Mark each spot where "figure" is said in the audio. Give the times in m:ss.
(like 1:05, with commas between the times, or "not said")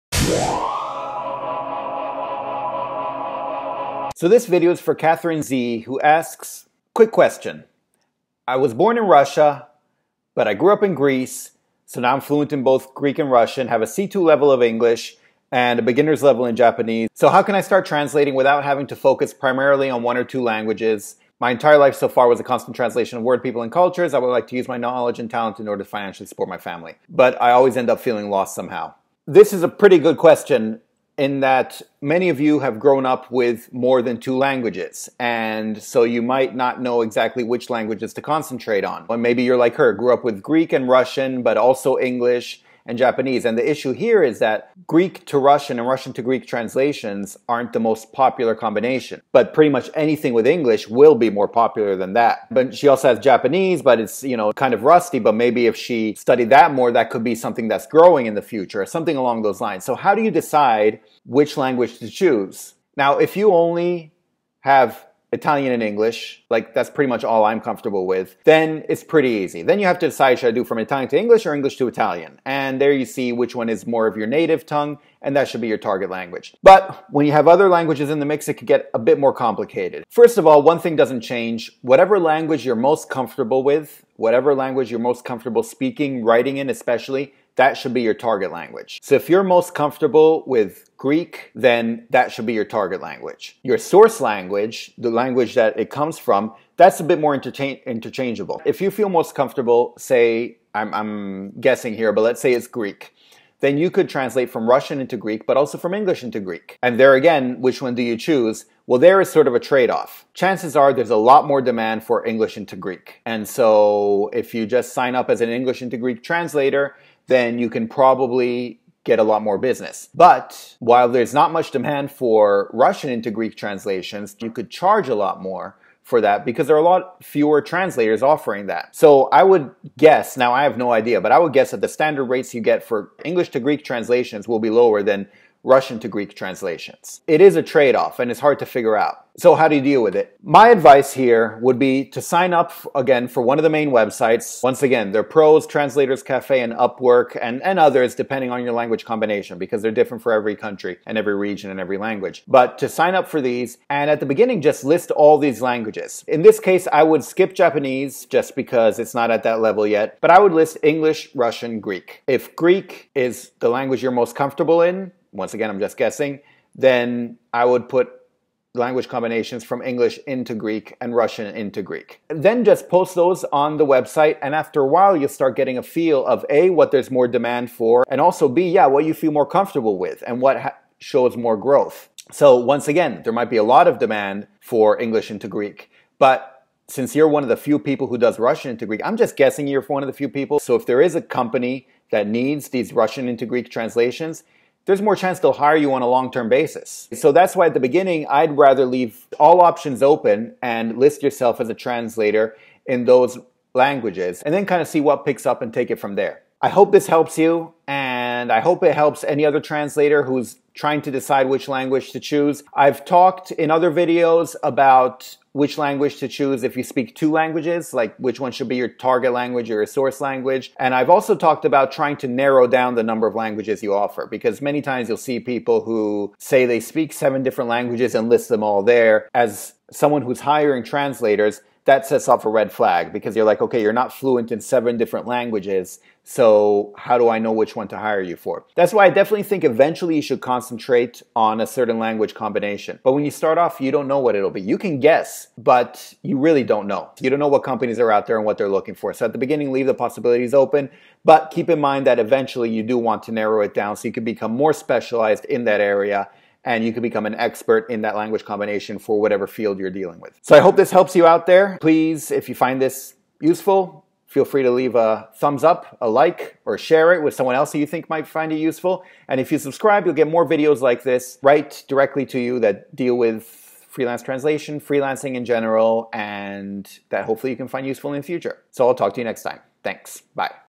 2:18.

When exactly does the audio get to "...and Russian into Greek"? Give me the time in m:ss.
2:51.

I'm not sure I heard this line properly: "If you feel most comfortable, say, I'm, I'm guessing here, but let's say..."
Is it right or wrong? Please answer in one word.
right.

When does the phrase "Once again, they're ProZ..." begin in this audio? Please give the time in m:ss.
2:24.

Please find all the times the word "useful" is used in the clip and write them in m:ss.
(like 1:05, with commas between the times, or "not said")
4:23, 4:28, 4:37.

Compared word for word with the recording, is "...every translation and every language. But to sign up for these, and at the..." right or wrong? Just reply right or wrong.
wrong.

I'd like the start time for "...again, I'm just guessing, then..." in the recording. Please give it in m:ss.
2:45.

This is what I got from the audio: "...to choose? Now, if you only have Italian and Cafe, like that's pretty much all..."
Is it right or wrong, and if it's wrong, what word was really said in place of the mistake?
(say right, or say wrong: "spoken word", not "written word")
wrong: "English", not "Cafe".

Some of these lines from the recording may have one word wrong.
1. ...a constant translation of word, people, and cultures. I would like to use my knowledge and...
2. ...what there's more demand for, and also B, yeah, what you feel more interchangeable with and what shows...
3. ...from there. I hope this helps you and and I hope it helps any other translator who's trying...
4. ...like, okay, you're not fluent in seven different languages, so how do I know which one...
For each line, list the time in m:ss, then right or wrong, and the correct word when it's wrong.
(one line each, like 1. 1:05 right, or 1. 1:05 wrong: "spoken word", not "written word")
1. 0:22 right
2. 2:56 wrong: "comfortable", not "interchangeable"
3. 3:25 right
4. 3:53 right.